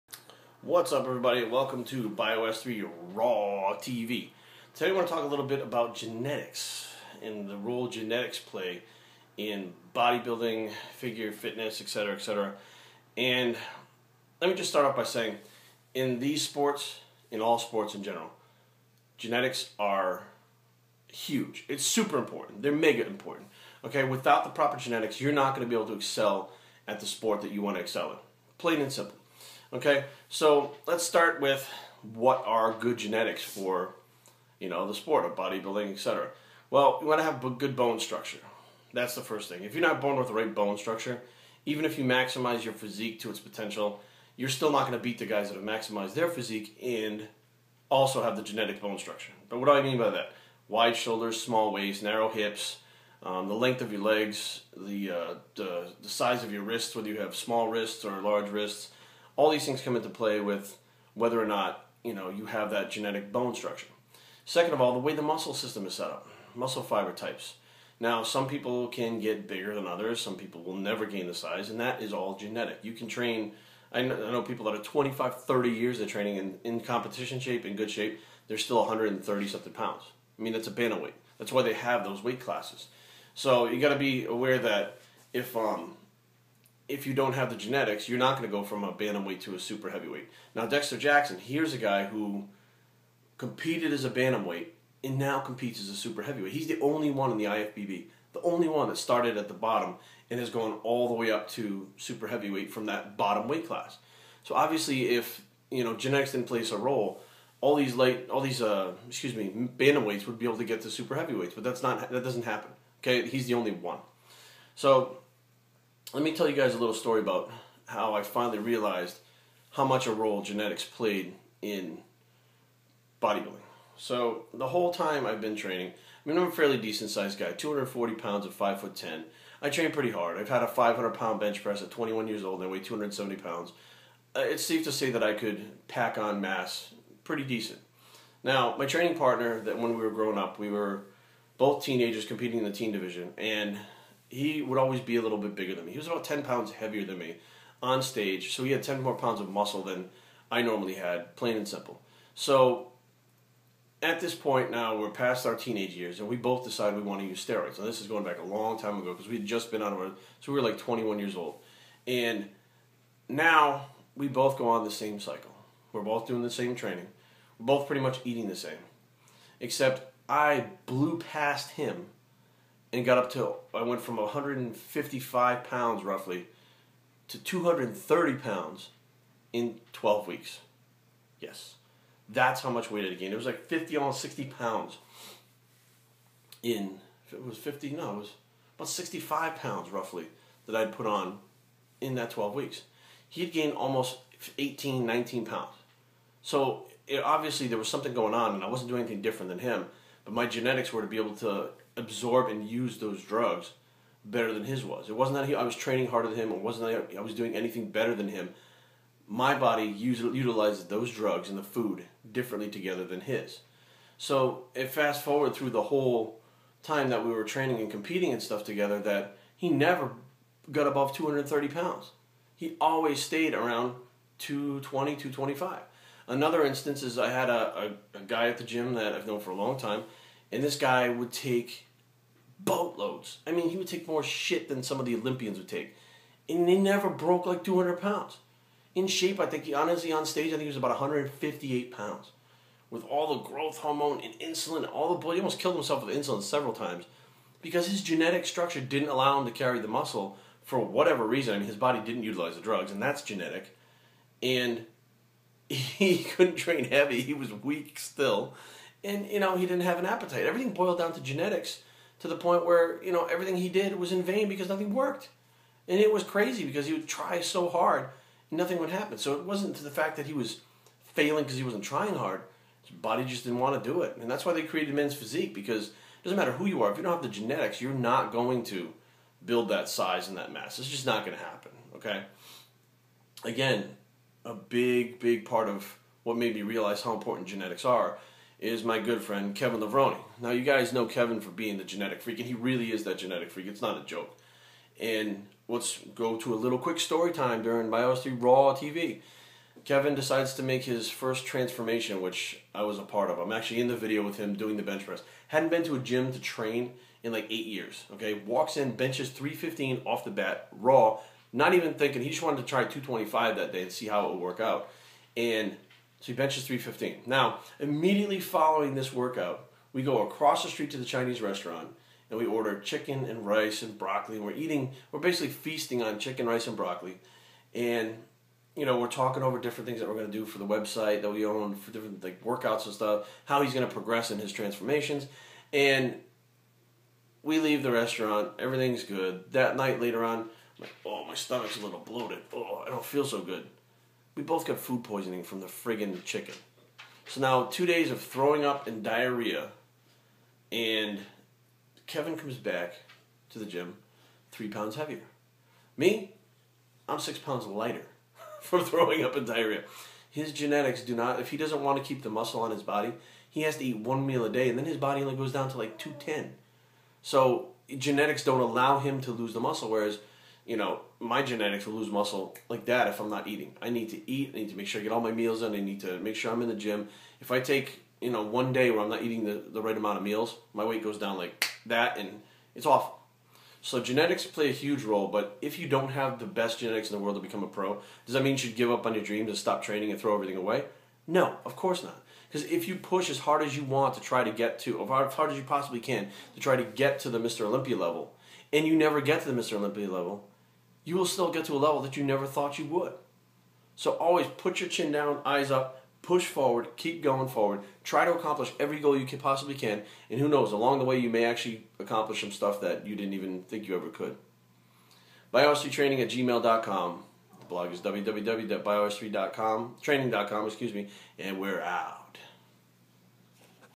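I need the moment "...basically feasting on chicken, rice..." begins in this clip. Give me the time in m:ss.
5:25.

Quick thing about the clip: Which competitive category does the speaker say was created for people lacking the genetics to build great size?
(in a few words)
men's physique.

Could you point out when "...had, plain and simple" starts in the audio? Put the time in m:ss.
2:30.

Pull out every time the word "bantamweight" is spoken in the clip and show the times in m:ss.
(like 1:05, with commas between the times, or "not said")
1:28, 1:34, 1:49.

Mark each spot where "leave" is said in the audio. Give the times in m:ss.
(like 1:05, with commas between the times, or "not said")
5:37.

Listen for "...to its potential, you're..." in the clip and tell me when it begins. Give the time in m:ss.
0:43.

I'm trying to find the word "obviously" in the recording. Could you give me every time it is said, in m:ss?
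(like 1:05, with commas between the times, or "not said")
1:44, 3:17.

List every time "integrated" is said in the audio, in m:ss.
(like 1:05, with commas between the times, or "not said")
not said.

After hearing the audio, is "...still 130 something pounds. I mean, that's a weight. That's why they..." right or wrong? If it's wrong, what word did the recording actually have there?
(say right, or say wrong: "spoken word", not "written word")
right.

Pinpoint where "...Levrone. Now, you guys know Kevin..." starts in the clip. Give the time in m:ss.
4:49.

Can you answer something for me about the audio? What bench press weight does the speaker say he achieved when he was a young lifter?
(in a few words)
500 pounds.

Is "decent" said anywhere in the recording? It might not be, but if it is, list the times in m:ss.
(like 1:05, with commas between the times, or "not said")
2:06, 2:17.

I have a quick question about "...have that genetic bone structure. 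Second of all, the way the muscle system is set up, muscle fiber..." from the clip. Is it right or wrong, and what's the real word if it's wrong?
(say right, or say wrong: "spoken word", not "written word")
right.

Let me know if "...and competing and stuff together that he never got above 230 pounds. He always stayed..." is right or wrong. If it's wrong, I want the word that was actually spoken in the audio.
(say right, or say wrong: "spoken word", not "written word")
right.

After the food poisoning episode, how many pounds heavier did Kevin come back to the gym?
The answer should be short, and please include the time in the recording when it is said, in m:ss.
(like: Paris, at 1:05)
3 pounds, at 5:54.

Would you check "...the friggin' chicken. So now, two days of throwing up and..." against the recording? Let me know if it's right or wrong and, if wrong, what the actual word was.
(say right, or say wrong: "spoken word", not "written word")
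right.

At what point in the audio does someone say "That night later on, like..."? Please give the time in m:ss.
5:39.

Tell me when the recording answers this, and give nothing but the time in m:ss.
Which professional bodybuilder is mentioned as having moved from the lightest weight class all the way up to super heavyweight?
1:30.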